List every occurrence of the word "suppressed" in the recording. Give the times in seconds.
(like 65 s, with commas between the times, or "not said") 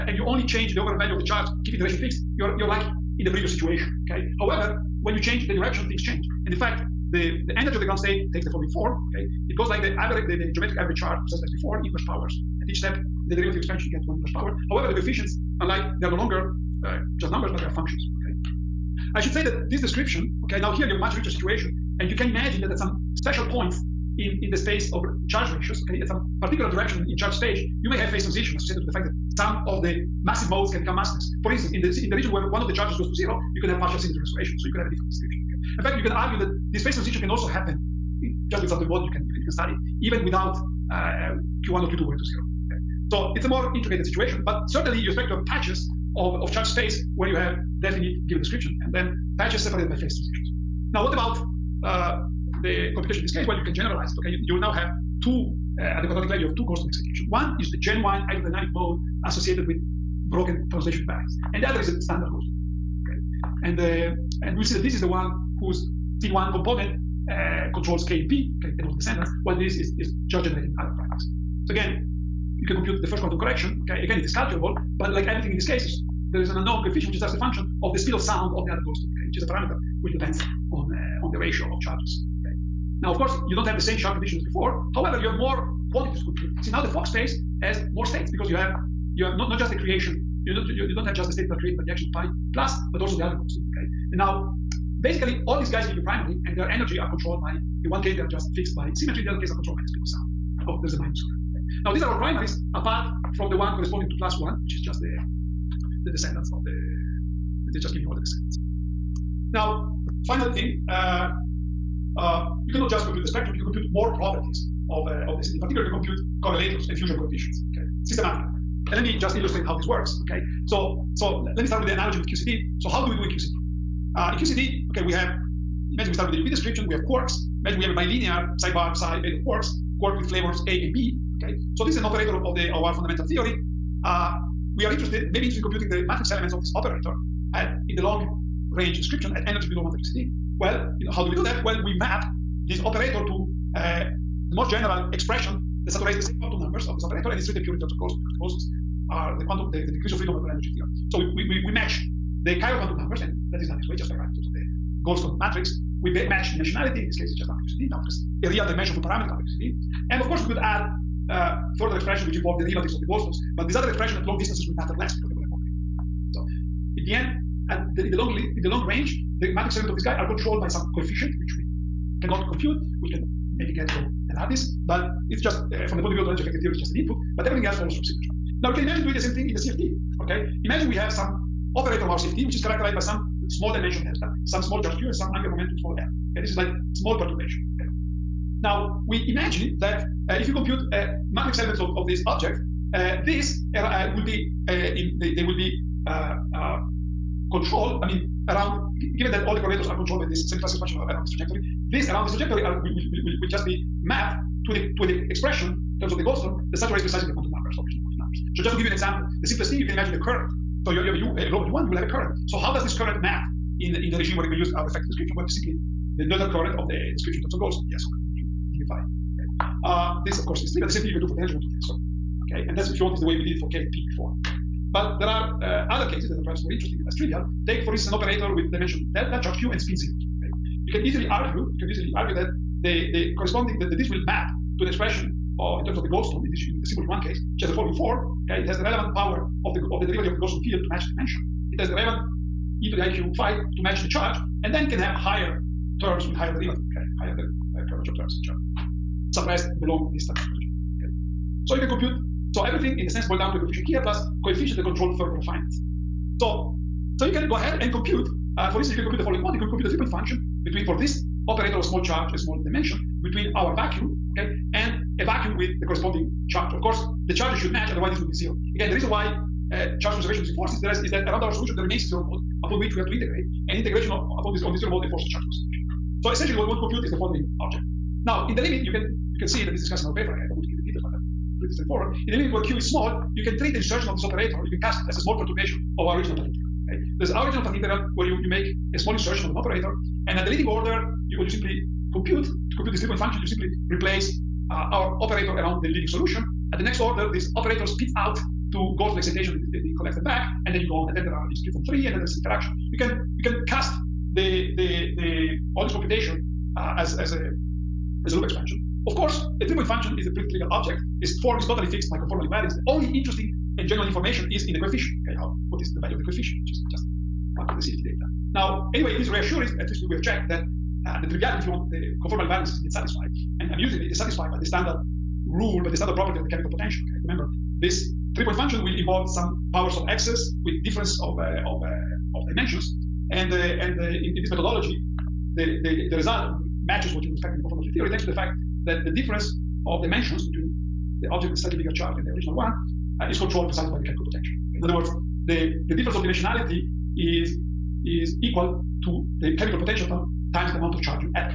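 249 s.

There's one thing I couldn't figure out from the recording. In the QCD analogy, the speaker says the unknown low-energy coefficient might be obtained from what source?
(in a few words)
the lattice.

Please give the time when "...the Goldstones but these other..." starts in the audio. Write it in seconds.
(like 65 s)
163 s.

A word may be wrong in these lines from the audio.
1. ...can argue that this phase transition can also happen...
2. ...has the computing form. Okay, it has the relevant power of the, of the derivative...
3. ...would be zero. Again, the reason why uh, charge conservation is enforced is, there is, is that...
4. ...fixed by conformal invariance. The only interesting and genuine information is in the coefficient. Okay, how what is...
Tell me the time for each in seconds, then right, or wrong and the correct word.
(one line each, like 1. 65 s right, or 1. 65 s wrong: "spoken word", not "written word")
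1. 36 s right
2. 237 s wrong: "following", not "computing"
3. 268 s right
4. 311 s right.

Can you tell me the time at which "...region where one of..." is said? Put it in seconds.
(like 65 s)
32 s.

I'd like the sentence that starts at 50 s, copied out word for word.
Now, what about uh, the computation in this case?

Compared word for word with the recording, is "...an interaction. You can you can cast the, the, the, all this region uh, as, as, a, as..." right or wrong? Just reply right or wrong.
wrong.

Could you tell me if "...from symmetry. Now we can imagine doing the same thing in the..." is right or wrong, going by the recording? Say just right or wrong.
right.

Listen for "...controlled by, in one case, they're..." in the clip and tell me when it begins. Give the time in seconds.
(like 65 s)
97 s.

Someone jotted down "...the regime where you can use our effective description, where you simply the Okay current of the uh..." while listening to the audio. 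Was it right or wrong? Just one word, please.
wrong.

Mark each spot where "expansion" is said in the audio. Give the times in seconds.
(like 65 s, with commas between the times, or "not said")
13 s, 200 s, 308 s.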